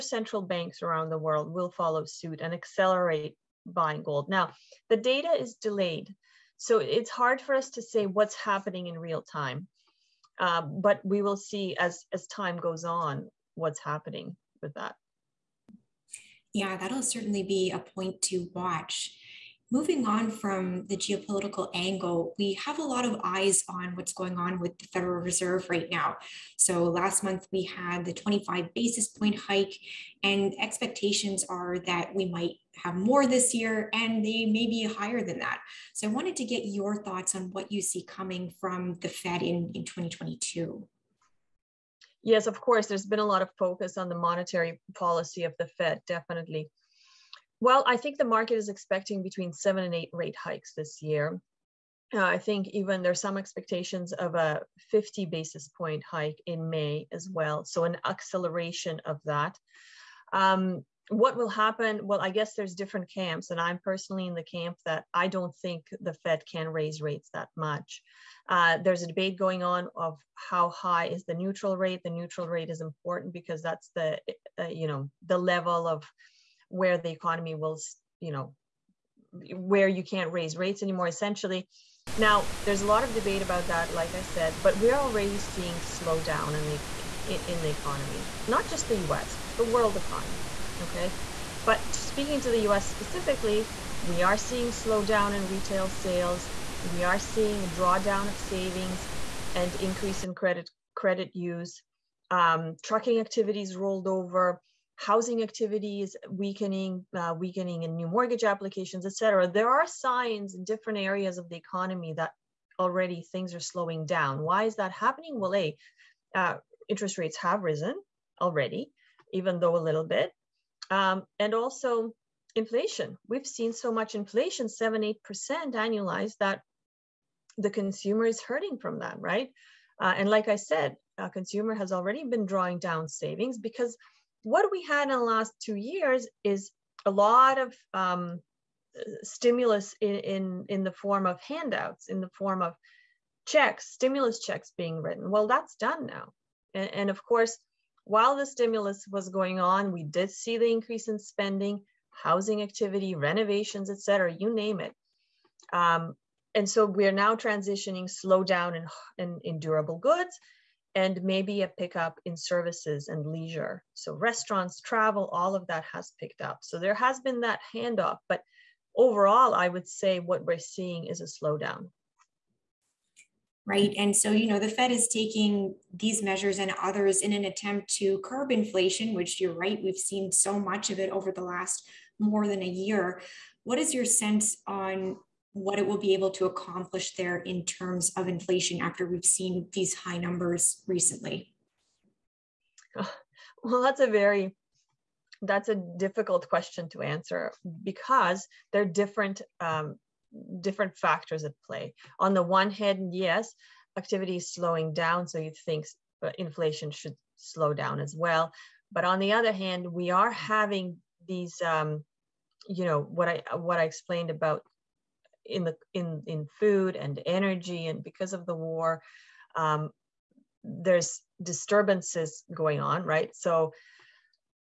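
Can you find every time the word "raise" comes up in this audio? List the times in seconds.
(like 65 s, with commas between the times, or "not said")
66 s, 80 s.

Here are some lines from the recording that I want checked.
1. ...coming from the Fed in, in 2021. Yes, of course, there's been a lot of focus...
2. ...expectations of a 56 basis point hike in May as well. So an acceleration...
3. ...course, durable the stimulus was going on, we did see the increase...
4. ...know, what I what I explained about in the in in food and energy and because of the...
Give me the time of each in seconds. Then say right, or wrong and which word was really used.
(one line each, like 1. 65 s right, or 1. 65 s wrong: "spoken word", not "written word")
1. 38 s wrong: "2022", not "2021"
2. 53 s wrong: "50", not "56"
3. 147 s wrong: "while", not "durable"
4. 212 s right.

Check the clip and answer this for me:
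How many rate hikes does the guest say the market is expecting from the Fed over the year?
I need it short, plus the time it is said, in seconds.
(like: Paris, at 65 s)
7 to 8, at 49 s.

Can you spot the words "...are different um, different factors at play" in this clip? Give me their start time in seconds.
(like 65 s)
198 s.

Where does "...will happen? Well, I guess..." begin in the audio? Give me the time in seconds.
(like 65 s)
61 s.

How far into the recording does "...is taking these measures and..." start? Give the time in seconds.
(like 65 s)
174 s.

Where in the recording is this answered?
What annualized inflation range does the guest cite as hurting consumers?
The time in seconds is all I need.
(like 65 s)
124 s.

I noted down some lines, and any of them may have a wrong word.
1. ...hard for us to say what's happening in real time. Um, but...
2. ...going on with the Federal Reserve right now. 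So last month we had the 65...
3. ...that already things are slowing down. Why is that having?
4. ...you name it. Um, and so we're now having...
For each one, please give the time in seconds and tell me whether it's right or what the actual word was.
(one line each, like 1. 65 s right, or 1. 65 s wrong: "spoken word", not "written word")
1. 7 s right
2. 24 s wrong: "25", not "65"
3. 112 s wrong: "happening", not "having"
4. 154 s wrong: "transitioning", not "having".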